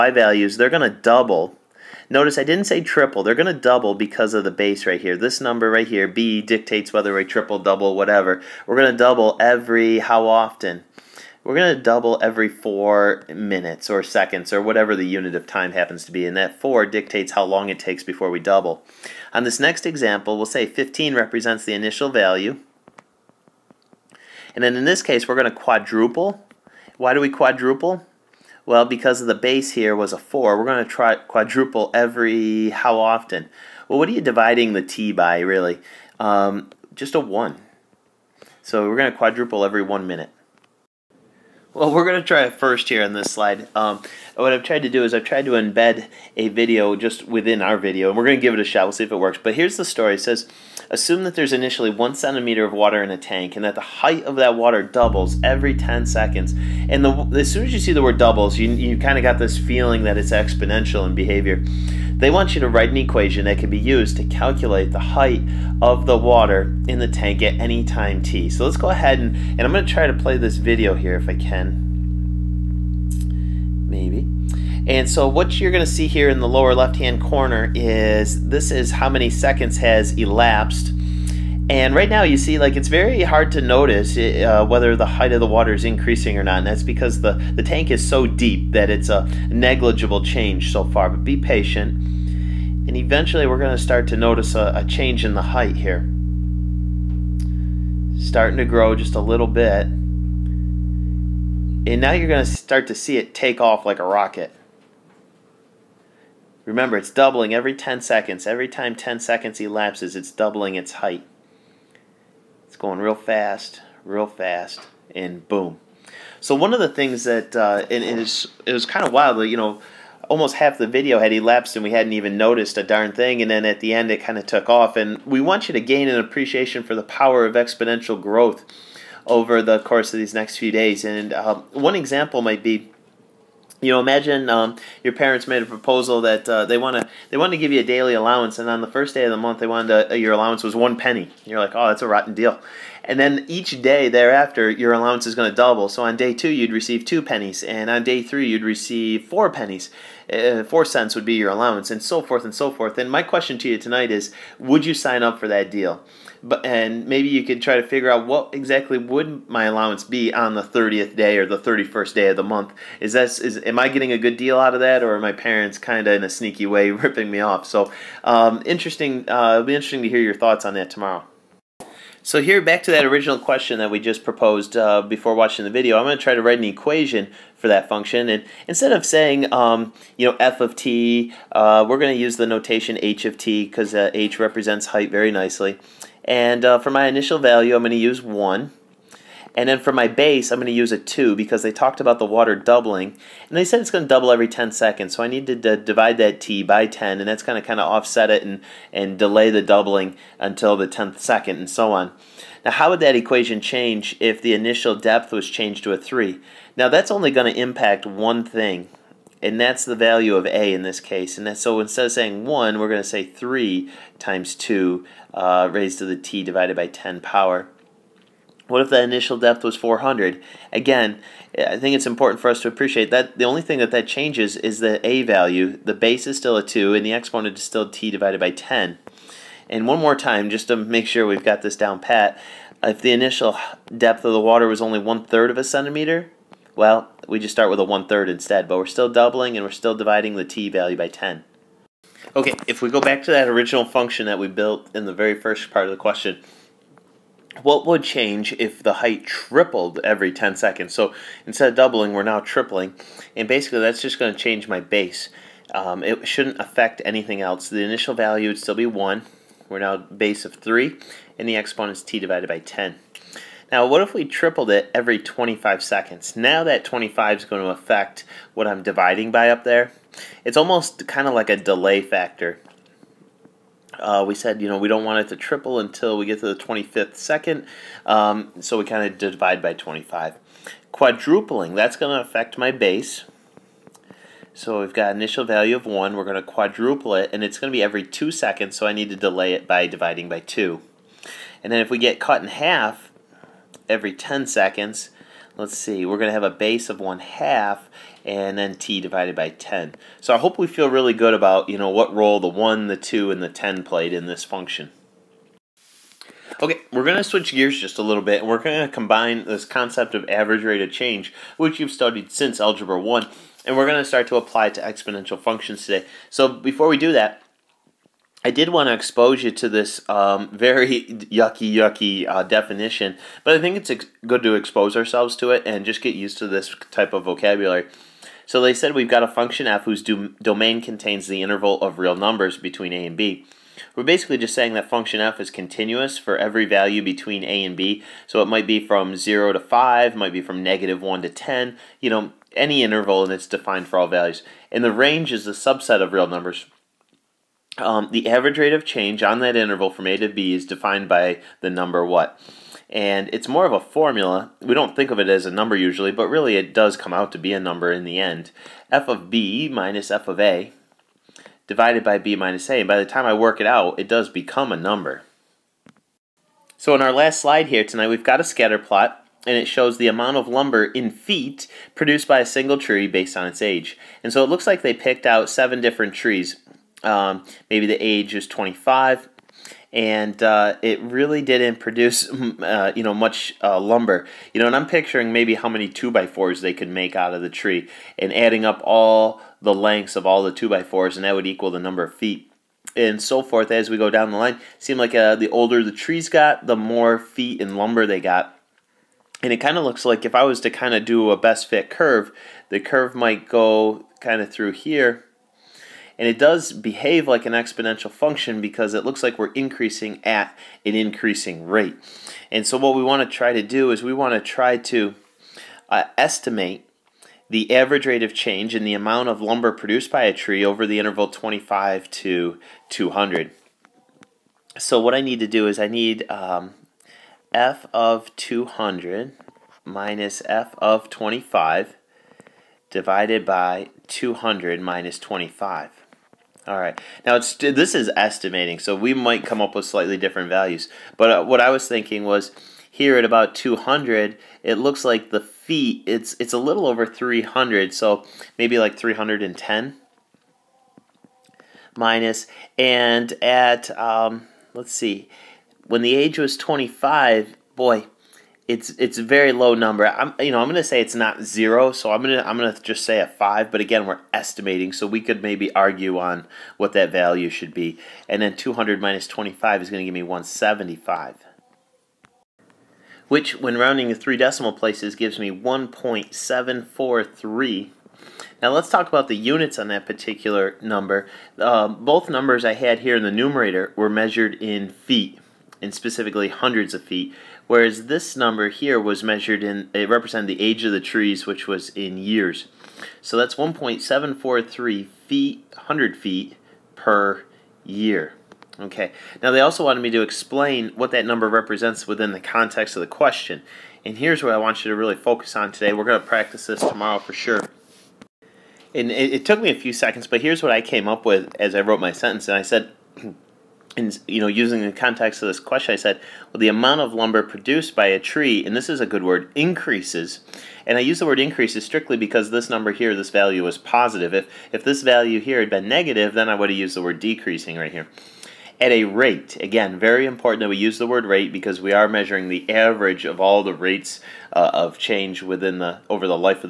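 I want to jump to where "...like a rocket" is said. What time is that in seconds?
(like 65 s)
103 s.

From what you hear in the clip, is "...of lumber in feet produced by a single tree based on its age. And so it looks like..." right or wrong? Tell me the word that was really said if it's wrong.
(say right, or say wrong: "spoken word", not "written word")
right.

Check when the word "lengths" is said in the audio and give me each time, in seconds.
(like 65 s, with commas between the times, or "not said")
389 s.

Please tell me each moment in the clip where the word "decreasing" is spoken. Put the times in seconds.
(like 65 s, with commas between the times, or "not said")
527 s.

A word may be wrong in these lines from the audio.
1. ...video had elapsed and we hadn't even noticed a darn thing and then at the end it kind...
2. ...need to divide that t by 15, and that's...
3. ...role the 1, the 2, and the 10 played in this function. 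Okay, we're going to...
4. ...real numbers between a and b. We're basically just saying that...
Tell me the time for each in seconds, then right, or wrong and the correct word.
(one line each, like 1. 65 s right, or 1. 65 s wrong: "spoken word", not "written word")
1. 120 s right
2. 195 s wrong: "10", not "15"
3. 302 s right
4. 331 s right.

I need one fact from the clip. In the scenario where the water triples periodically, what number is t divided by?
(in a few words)
25.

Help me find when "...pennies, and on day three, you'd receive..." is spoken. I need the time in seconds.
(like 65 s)
147 s.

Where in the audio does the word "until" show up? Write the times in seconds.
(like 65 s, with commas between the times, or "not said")
200 s, 275 s.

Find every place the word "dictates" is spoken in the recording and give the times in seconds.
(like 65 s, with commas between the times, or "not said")
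6 s, 16 s.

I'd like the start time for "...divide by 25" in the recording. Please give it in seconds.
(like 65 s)
279 s.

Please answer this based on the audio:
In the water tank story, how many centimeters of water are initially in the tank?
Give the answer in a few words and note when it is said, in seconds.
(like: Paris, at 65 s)
1 centimeter, at 51 s.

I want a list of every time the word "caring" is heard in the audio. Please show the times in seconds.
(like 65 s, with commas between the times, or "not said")
not said.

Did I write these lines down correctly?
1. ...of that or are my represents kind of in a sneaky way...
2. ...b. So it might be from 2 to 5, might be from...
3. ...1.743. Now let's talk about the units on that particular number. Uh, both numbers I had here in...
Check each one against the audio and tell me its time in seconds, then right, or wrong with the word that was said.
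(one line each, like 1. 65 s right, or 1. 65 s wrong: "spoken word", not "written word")
1. 164 s wrong: "parents", not "represents"
2. 337 s wrong: "0", not "2"
3. 475 s right.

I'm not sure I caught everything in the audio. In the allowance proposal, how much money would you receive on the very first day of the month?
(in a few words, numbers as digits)
one penny.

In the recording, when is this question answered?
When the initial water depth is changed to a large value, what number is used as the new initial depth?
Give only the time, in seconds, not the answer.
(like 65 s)
219 s.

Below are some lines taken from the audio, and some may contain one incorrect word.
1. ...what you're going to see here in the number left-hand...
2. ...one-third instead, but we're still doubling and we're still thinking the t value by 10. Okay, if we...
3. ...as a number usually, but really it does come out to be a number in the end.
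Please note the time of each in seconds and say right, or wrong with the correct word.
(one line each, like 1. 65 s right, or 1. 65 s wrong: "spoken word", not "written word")
1. 75 s wrong: "lower", not "number"
2. 237 s wrong: "dividing", not "thinking"
3. 355 s right.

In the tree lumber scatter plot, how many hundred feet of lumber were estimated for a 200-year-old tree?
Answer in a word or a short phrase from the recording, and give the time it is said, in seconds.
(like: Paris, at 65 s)
310, at 448 s.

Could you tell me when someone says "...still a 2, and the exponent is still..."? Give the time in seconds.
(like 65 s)
226 s.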